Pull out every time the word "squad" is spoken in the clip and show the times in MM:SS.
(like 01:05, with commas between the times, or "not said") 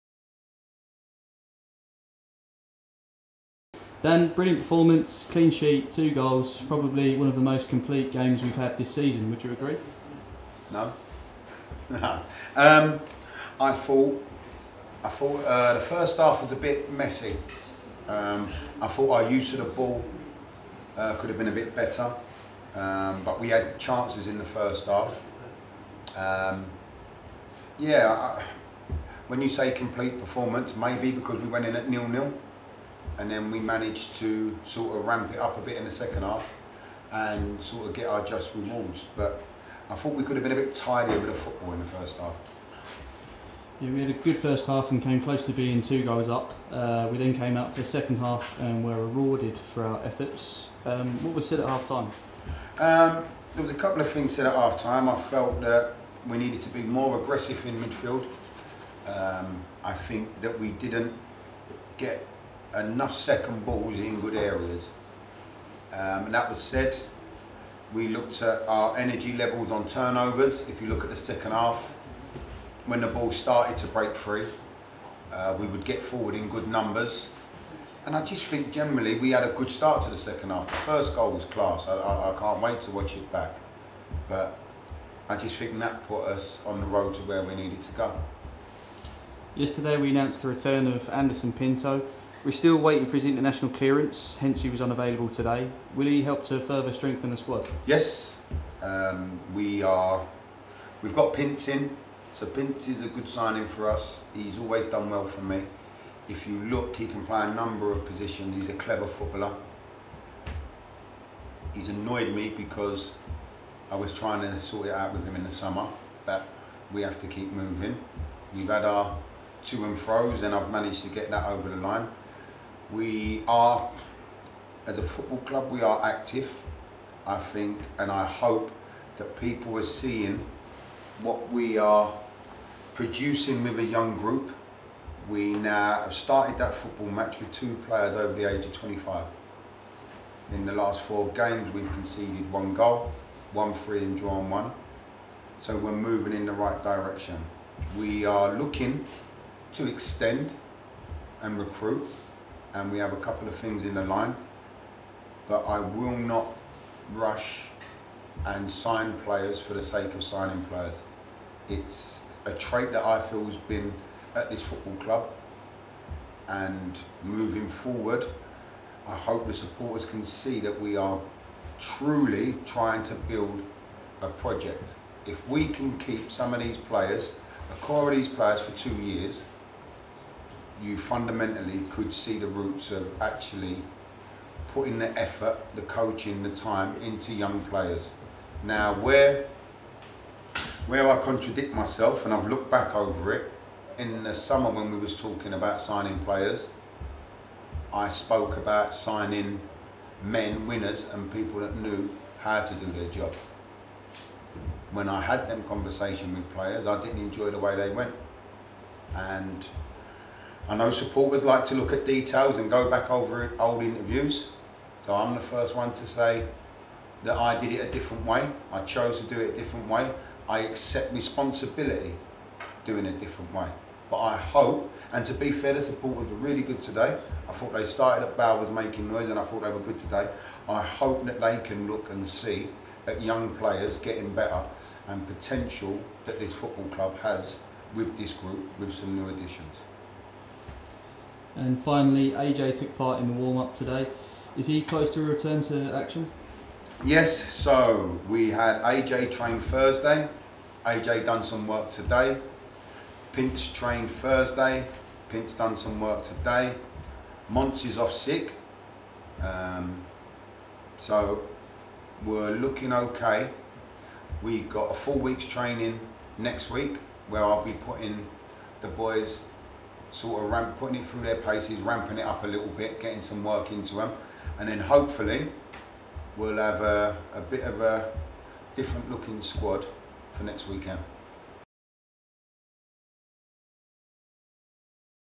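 01:37, 04:39.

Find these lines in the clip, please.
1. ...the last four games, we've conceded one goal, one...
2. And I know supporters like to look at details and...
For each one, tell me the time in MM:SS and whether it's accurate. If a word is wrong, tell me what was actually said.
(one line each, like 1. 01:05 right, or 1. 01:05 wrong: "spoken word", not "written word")
1. 02:20 right
2. 03:29 right.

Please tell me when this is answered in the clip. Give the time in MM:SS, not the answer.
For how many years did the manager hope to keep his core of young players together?
02:58.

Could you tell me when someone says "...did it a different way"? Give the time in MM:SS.
03:37.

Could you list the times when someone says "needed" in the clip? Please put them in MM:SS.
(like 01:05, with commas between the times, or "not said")
00:56, 01:27.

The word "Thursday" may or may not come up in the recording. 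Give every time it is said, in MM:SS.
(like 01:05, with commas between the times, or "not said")
04:09, 04:14.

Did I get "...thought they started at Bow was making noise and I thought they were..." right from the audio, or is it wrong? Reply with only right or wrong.
right.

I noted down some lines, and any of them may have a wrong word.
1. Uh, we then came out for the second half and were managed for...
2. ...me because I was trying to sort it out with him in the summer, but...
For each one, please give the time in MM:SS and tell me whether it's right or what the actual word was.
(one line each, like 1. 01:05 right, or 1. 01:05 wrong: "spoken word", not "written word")
1. 00:46 wrong: "rewarded", not "managed"
2. 01:52 right.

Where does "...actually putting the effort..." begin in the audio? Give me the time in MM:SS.
03:03.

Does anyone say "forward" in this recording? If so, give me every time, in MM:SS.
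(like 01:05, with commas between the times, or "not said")
01:16, 02:47.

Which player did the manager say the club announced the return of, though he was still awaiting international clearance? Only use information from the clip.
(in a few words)
Anderson Pinto.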